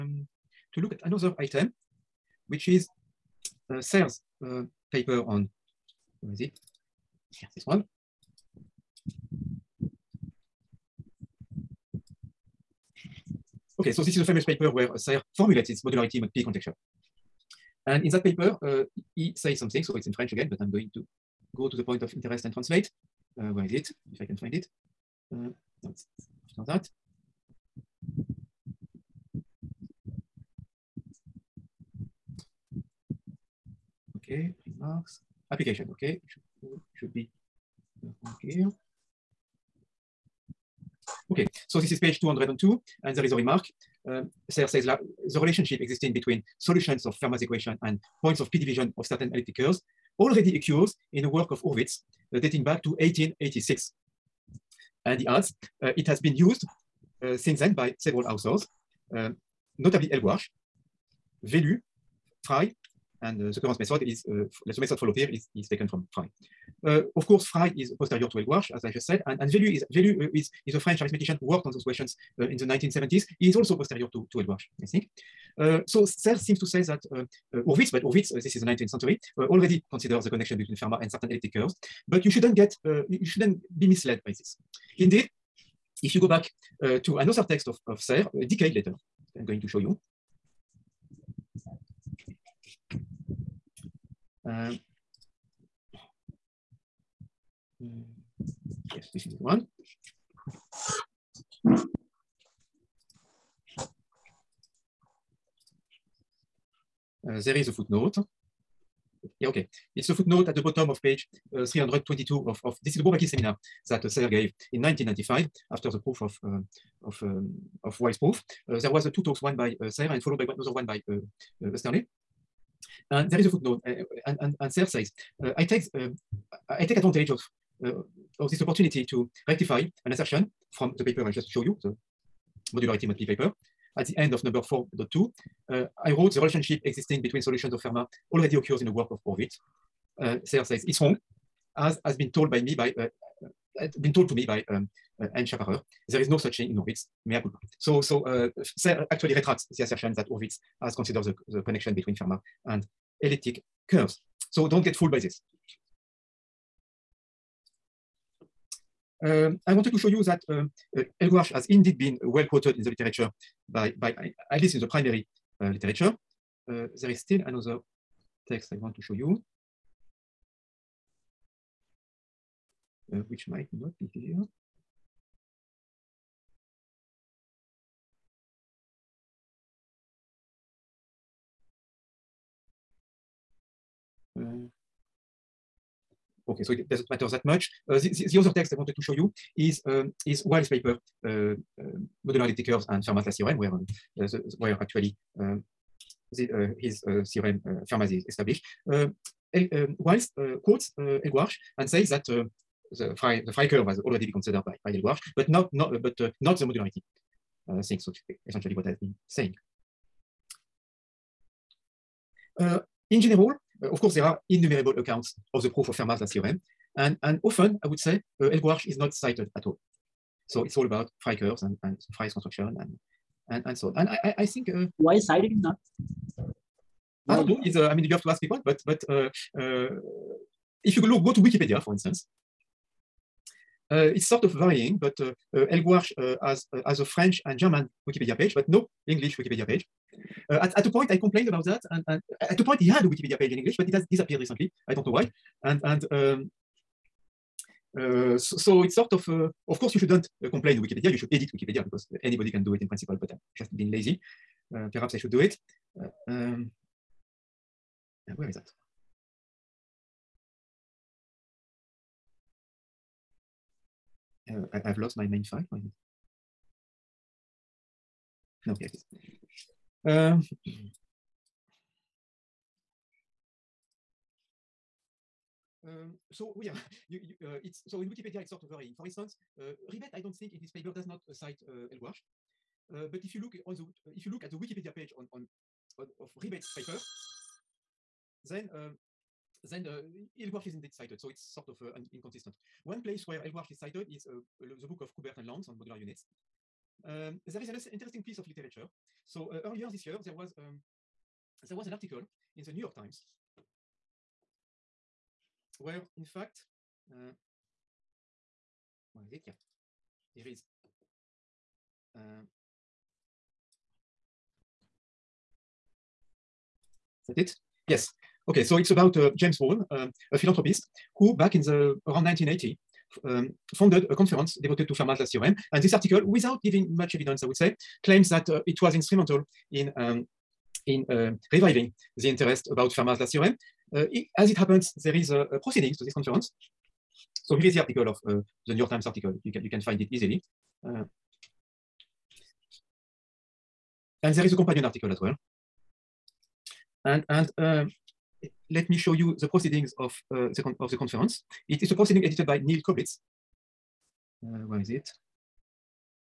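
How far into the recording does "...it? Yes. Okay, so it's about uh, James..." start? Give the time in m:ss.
5:17.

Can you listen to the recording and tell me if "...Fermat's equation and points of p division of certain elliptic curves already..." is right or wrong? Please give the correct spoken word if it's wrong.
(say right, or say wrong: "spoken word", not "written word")
right.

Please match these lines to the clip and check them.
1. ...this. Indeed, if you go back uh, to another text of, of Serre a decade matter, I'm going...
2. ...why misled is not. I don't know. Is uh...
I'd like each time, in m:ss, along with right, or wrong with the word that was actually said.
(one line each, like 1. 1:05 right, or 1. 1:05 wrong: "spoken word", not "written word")
1. 1:24 wrong: "later", not "matter"
2. 3:44 wrong: "sided", not "misled".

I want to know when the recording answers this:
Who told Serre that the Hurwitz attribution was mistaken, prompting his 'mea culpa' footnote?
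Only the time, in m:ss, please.
2:25.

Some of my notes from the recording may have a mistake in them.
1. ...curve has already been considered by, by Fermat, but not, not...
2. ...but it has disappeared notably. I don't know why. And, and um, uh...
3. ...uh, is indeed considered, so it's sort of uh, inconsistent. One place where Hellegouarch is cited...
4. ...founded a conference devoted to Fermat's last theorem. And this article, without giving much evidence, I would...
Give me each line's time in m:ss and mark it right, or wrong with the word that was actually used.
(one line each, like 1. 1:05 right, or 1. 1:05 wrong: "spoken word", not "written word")
1. 3:23 wrong: "Hellegouarch", not "Fermat"
2. 4:03 wrong: "recently", not "notably"
3. 4:49 wrong: "cited", not "considered"
4. 5:23 right.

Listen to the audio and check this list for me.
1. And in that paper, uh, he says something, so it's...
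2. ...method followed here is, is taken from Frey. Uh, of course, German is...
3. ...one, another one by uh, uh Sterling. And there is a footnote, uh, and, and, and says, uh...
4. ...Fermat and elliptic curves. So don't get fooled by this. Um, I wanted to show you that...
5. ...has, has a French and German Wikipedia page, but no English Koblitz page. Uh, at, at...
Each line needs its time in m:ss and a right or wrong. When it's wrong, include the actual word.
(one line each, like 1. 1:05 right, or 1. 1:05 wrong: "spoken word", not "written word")
1. 0:17 right
2. 1:04 wrong: "Frey", not "German"
3. 2:00 right
4. 2:32 right
5. 3:56 wrong: "Wikipedia", not "Koblitz".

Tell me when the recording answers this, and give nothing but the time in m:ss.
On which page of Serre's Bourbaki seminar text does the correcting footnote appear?
1:51.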